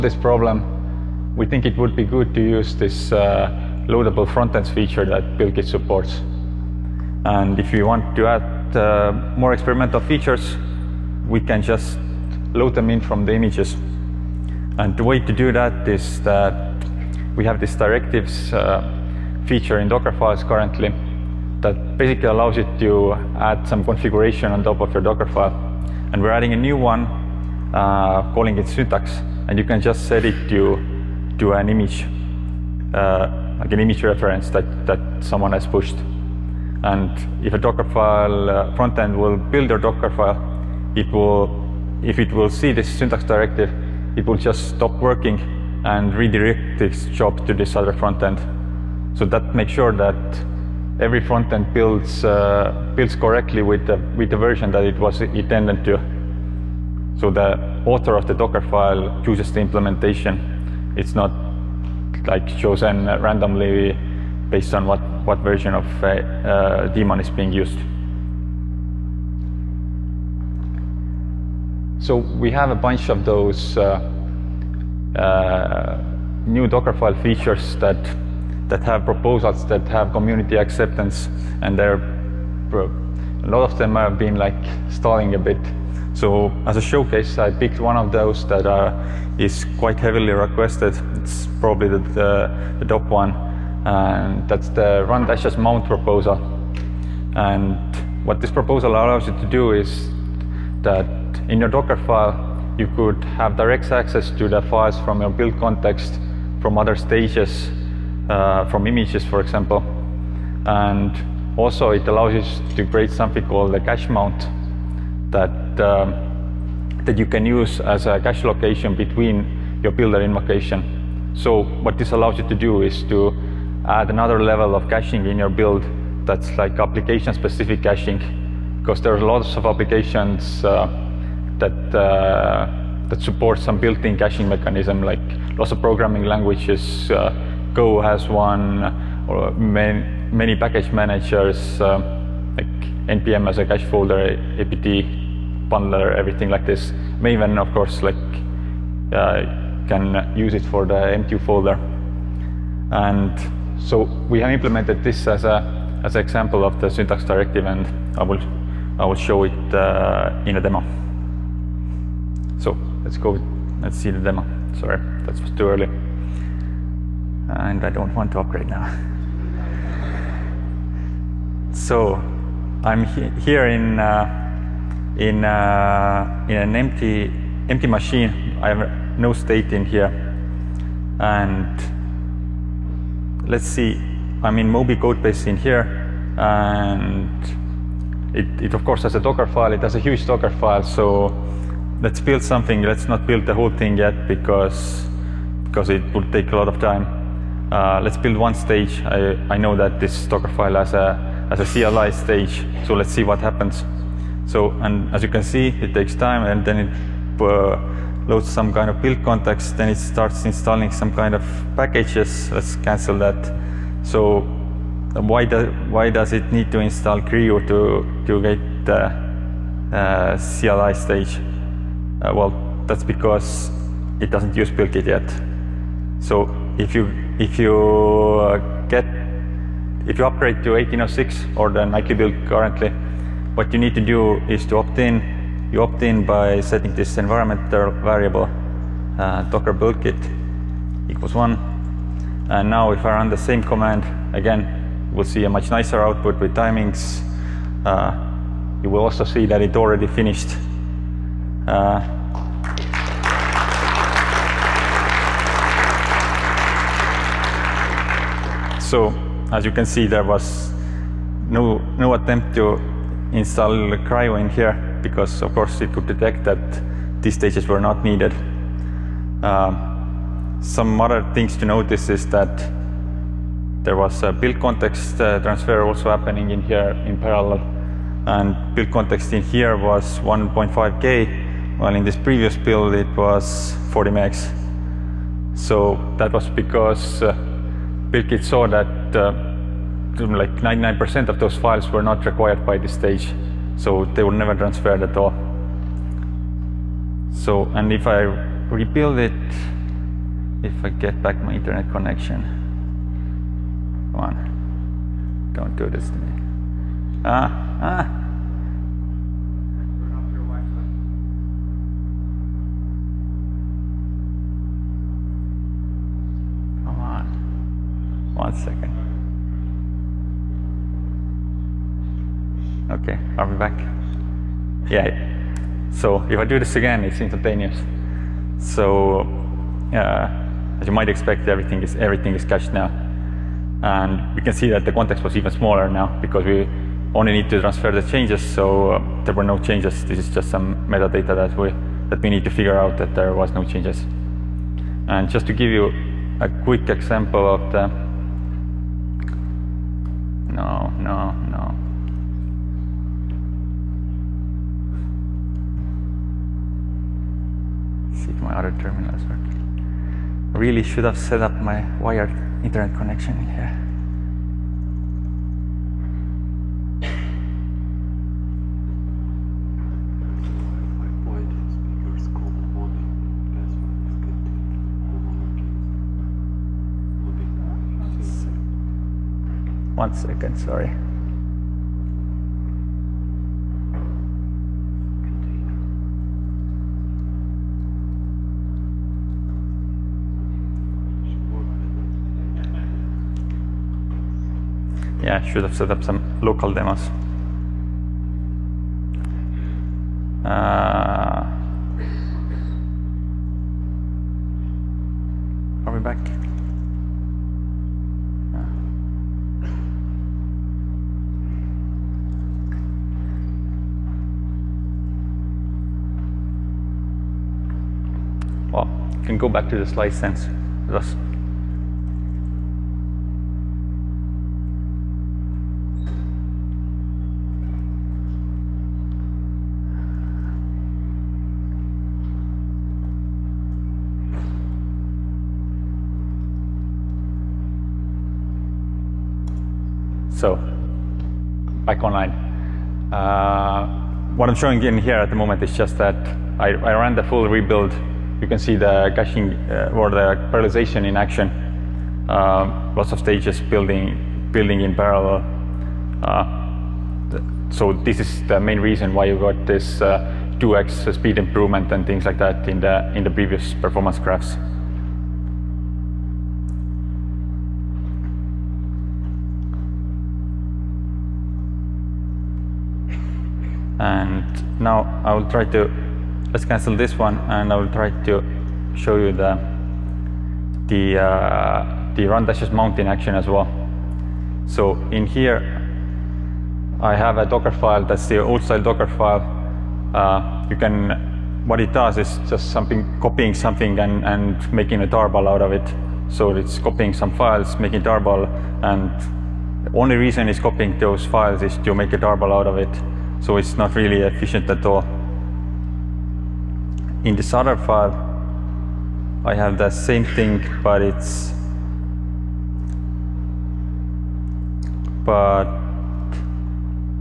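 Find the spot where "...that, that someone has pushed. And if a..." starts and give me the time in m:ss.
0:34.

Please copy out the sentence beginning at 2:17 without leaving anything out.
Uh, Go has one, or many, many package managers, uh, like npm as a cache folder, apt bundler, everything like this.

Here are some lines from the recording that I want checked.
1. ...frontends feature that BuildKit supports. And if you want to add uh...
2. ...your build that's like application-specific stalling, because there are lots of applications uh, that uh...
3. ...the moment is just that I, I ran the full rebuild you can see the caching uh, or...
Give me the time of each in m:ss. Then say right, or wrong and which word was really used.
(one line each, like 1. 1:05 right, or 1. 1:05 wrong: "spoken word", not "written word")
1. 0:04 right
2. 2:05 wrong: "caching", not "stalling"
3. 7:25 right.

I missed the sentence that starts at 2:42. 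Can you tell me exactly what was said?
So let's go, let's see the demo.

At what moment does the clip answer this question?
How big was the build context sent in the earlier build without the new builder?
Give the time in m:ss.
4:43.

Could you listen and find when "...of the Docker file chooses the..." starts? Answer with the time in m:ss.
0:58.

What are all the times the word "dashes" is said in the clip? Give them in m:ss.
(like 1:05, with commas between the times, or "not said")
1:35, 8:02.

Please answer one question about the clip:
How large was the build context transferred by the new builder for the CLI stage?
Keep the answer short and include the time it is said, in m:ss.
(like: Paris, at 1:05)
1.5K, at 4:40.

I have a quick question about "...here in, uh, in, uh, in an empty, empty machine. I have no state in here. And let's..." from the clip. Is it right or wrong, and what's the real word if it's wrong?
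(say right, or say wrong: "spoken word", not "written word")
right.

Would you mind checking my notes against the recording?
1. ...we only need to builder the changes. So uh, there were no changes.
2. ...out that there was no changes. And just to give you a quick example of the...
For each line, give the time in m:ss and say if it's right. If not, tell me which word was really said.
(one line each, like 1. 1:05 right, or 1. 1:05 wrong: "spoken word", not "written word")
1. 5:36 wrong: "transfer", not "builder"
2. 5:42 right.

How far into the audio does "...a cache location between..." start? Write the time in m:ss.
1:58.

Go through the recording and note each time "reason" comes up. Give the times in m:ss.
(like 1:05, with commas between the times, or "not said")
7:38, 8:20.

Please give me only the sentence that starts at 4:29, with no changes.
Um, some other things to notice is that there was a build context uh, transfer also happening in here in parallel.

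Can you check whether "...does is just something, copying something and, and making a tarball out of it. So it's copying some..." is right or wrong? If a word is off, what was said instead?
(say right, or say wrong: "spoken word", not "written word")
right.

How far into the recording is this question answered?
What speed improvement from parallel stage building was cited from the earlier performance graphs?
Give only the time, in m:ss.
7:39.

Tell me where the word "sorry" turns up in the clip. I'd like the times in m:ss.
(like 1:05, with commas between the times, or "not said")
2:44, 6:20.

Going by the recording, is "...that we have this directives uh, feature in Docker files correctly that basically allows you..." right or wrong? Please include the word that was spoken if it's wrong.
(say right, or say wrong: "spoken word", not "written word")
wrong: "currently", not "correctly".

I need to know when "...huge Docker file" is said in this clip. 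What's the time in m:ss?
3:09.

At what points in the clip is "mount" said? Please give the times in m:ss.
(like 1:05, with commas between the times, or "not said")
1:35, 1:54, 8:02.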